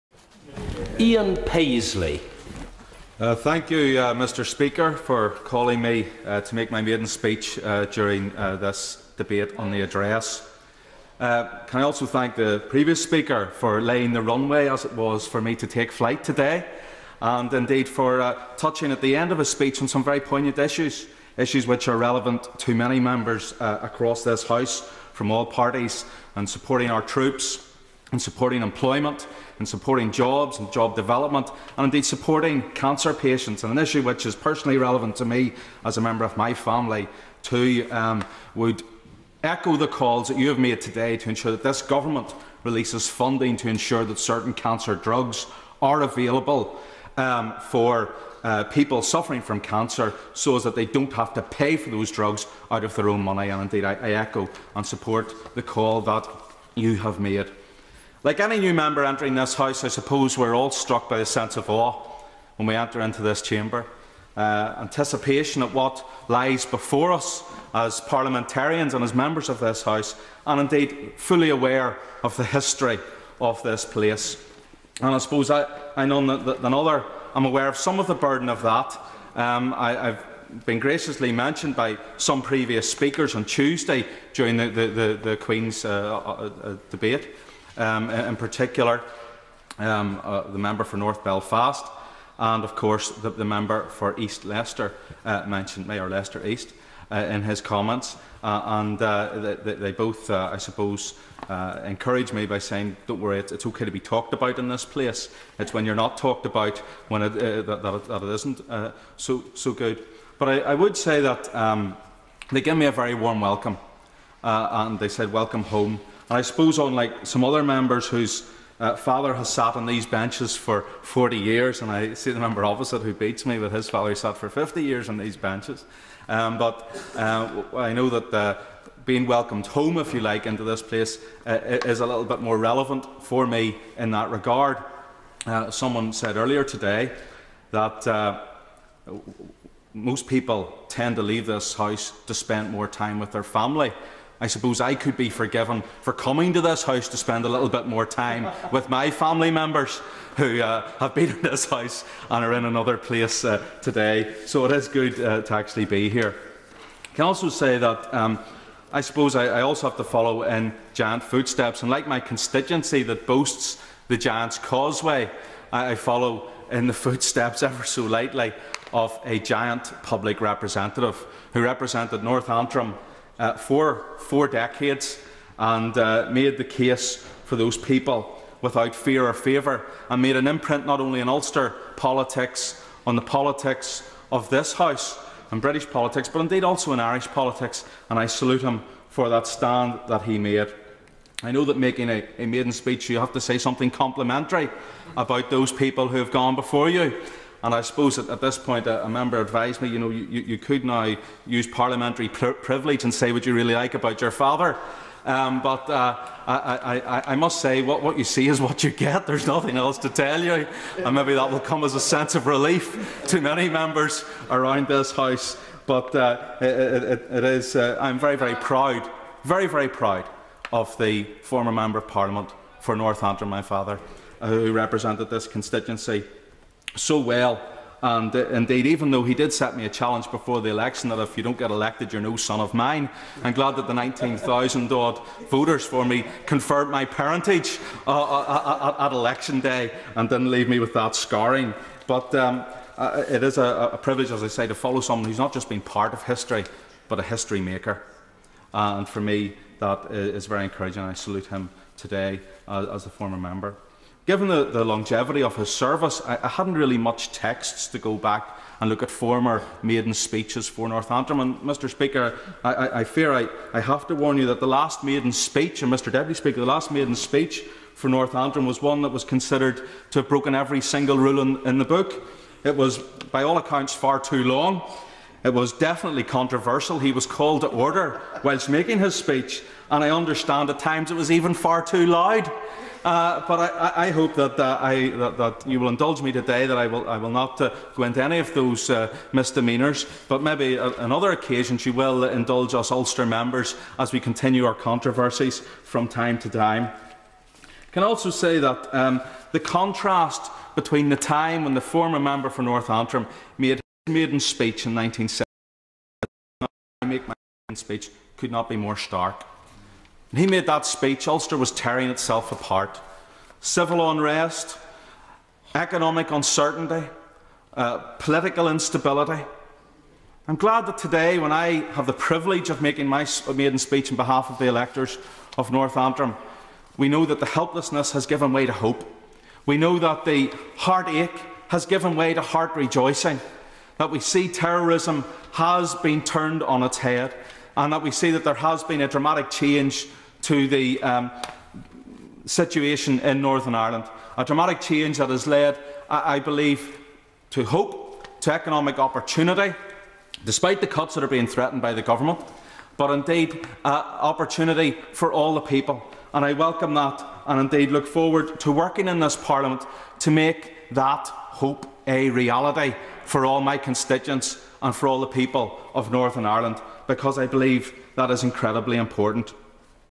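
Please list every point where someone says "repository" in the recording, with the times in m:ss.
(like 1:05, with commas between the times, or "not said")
not said.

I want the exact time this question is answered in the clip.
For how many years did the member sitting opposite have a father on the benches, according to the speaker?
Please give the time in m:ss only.
2:04.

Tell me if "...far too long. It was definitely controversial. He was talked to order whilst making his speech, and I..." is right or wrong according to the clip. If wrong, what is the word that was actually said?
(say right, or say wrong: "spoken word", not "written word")
wrong: "called", not "talked".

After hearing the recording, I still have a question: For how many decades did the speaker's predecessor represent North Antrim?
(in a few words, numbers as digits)
4.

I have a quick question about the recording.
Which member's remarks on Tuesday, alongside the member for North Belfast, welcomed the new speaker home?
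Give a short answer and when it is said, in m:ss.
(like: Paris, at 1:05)
Leicester East, at 1:36.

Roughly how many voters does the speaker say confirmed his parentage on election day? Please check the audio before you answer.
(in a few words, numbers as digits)
19,000.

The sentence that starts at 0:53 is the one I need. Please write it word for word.
And indeed, I, I echo and support the call that you have made.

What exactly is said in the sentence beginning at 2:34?
So it is good uh, to actually be here.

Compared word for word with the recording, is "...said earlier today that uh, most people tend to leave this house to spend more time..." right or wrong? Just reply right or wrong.
right.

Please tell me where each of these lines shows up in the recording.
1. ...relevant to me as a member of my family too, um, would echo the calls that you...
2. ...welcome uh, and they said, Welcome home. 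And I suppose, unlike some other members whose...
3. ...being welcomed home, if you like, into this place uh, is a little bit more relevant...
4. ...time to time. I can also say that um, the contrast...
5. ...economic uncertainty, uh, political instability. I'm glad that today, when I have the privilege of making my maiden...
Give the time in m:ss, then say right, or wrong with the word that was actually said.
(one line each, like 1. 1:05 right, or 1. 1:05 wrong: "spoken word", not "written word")
1. 0:34 right
2. 1:53 right
3. 2:09 right
4. 4:56 right
5. 5:15 right.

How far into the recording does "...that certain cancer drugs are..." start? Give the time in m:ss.
0:44.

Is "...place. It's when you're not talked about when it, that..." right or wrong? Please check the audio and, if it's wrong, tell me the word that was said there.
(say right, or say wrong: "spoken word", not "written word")
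right.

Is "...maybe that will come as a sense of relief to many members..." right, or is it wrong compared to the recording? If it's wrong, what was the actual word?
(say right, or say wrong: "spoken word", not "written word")
right.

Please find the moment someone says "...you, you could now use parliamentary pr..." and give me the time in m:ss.
3:20.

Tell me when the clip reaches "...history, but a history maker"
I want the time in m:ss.
4:06.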